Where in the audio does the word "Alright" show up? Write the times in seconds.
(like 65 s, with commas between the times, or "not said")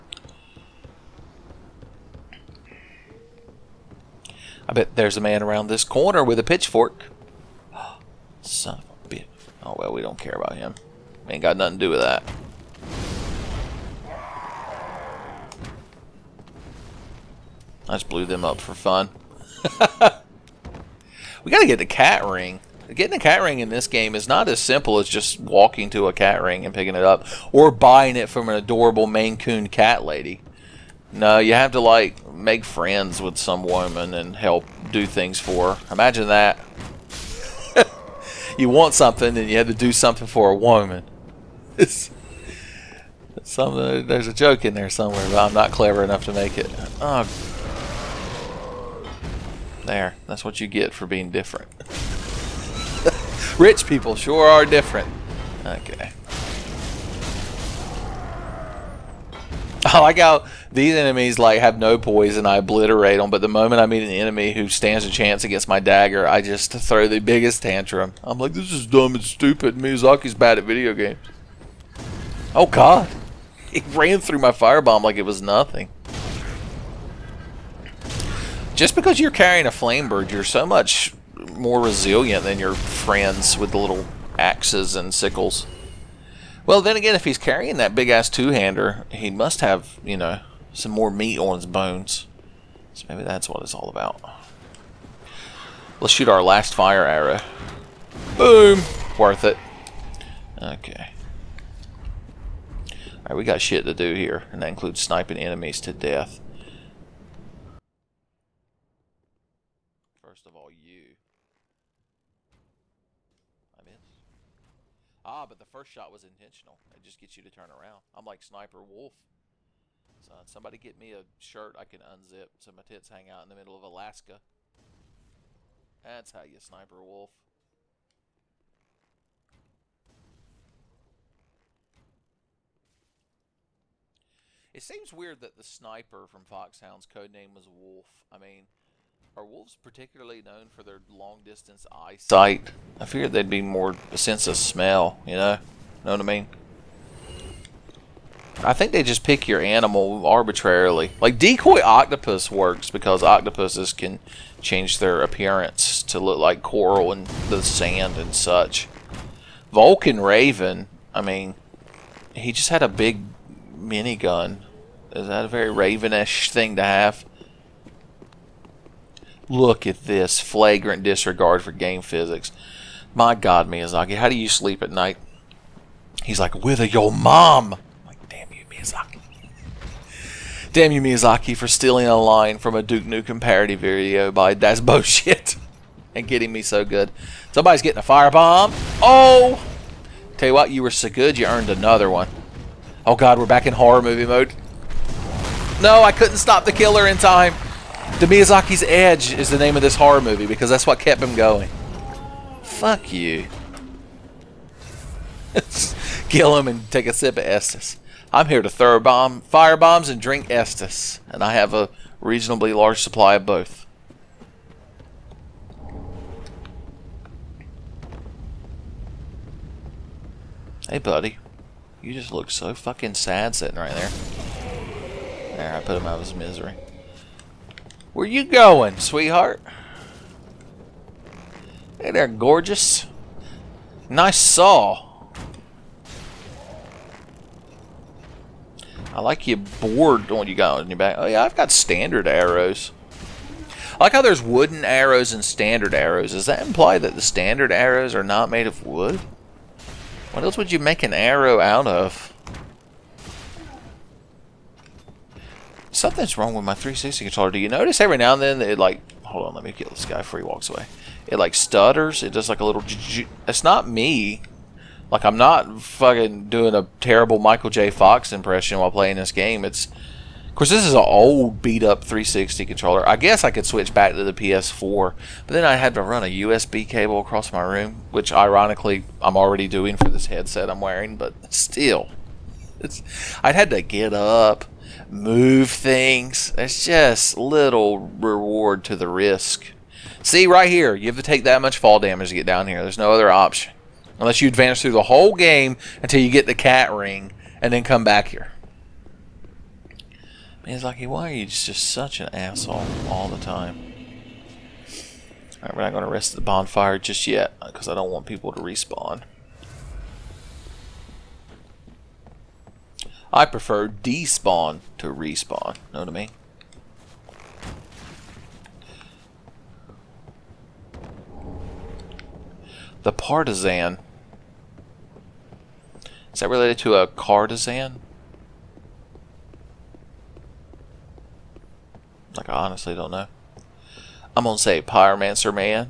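103 s, 305 s.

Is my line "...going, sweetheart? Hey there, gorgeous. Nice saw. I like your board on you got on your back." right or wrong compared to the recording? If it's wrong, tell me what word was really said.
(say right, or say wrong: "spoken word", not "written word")
right.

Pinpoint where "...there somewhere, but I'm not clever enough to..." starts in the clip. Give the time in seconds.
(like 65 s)
44 s.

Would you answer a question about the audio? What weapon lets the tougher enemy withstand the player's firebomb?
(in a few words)
flamberge.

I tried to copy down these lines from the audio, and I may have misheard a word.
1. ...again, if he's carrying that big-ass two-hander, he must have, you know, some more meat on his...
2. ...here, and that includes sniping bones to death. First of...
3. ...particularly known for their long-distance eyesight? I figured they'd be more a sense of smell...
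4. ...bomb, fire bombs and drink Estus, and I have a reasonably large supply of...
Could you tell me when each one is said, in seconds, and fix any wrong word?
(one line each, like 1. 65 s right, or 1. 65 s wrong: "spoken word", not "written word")
1. 86 s right
2. 104 s wrong: "enemies", not "bones"
3. 139 s right
4. 208 s right.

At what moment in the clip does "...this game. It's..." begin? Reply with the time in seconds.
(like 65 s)
269 s.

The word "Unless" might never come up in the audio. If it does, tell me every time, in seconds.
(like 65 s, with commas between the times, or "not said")
294 s.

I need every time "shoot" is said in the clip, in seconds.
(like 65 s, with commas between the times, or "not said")
96 s.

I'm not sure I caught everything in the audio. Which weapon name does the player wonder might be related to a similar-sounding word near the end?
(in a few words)
partisan.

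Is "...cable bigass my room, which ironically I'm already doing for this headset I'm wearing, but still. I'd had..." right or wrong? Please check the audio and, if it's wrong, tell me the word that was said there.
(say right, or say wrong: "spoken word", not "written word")
wrong: "across", not "bigass".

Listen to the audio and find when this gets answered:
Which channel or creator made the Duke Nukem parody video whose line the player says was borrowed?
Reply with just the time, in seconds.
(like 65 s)
184 s.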